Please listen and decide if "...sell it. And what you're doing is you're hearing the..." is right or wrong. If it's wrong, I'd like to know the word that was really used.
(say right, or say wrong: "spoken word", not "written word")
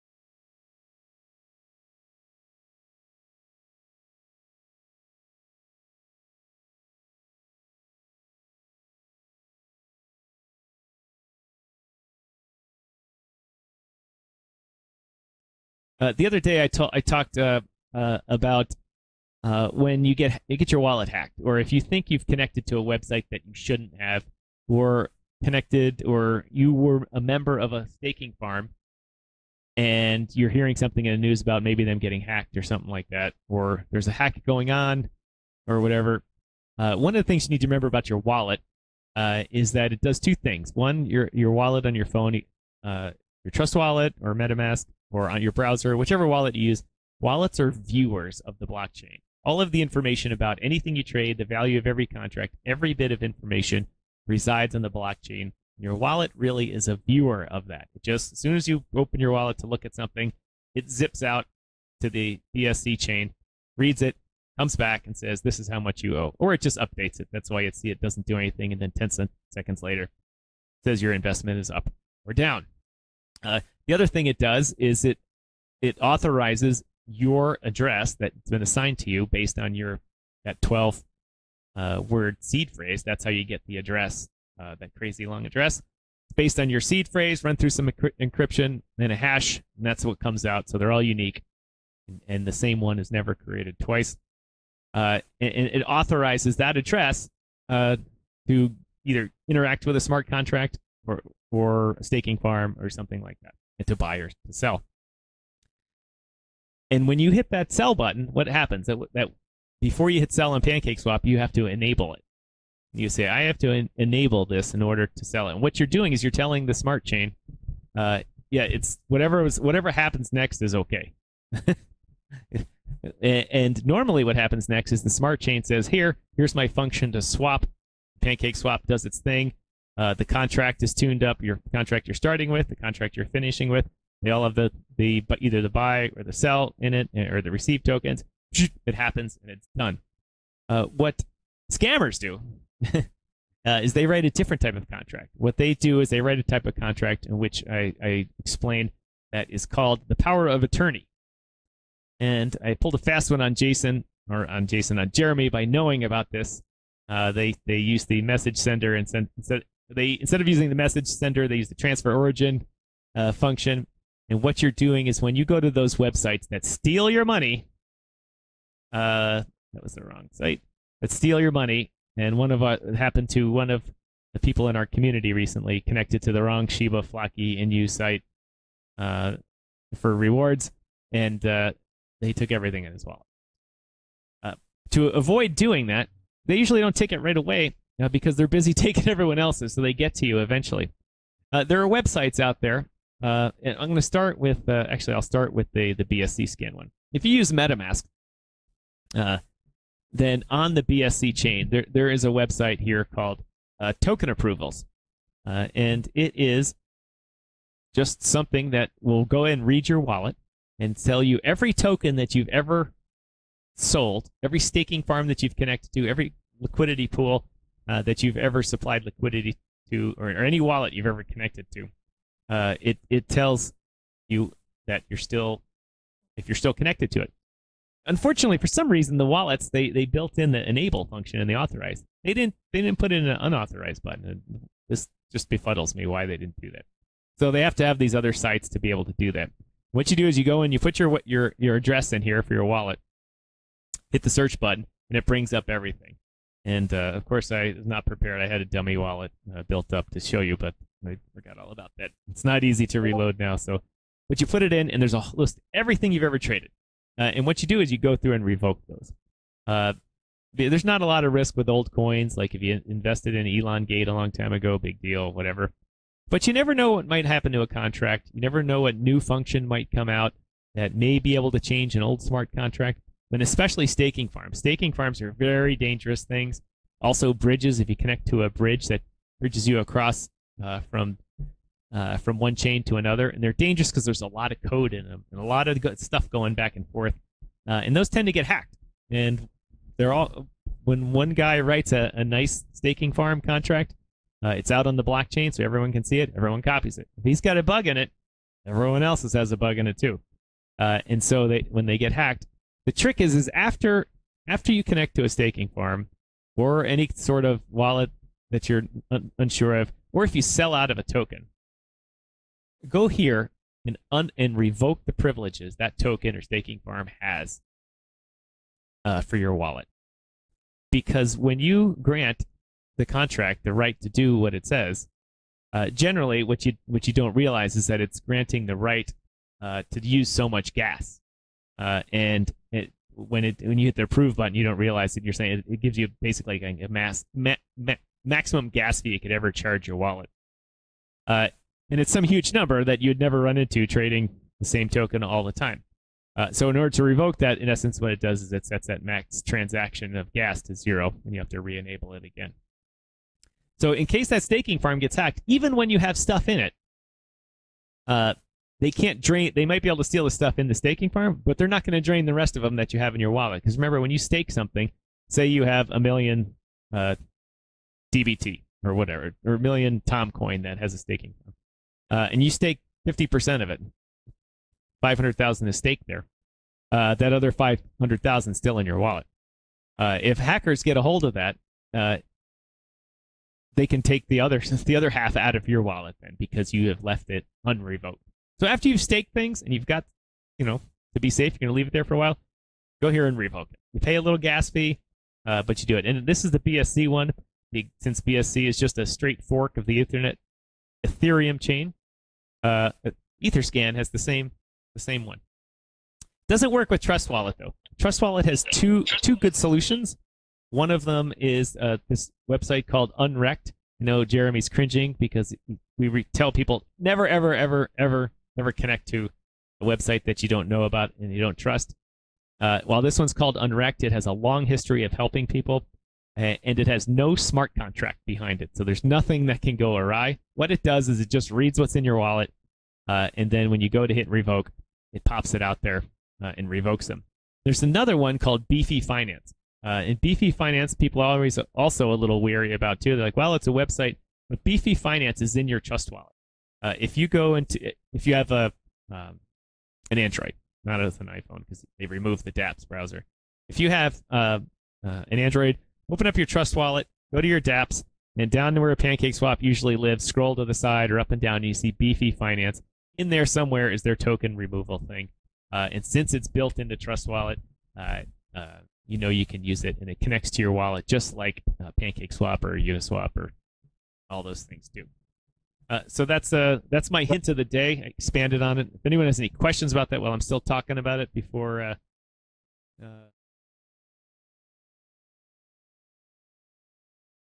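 wrong: "telling", not "hearing".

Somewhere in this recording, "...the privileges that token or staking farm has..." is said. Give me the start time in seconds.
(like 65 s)
315 s.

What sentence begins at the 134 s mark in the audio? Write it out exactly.
They all have the the either the buy or the sell in it, eh, or the receive tokens.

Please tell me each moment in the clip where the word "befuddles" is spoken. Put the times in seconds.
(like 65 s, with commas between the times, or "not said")
235 s.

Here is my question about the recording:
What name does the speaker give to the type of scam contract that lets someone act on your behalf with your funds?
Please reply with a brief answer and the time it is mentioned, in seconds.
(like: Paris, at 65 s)
power of attorney, at 150 s.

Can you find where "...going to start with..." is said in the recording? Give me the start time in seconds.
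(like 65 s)
193 s.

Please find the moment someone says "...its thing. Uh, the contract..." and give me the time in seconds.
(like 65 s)
129 s.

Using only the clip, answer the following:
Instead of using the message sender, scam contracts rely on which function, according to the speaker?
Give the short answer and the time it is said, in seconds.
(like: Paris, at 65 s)
transfer origin, at 161 s.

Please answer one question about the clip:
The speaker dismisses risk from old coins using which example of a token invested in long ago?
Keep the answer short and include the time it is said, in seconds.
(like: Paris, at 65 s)
Elon Gate, at 263 s.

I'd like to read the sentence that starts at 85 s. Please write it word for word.
It's based on your seed phrase, run through some encryption and a hash, and that's what comes out.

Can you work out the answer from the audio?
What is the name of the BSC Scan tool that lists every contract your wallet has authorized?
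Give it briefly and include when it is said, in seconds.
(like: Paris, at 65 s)
Token Approvals, at 204 s.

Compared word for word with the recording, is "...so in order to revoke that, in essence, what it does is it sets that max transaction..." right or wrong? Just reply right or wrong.
right.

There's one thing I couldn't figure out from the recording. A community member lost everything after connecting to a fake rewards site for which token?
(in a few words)
Shiba Floki Inu.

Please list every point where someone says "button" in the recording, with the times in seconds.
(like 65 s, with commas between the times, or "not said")
107 s, 234 s, 244 s, 334 s.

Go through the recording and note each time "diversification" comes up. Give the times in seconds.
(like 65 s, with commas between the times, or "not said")
not said.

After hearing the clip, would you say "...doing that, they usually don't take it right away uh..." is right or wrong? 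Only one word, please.
right.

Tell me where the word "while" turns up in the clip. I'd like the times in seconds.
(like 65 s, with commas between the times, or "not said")
392 s, 422 s, 480 s.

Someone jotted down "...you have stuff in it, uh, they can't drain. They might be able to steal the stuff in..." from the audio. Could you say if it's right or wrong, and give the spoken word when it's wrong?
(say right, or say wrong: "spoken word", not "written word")
right.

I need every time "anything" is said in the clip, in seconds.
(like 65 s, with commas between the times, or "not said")
50 s, 68 s.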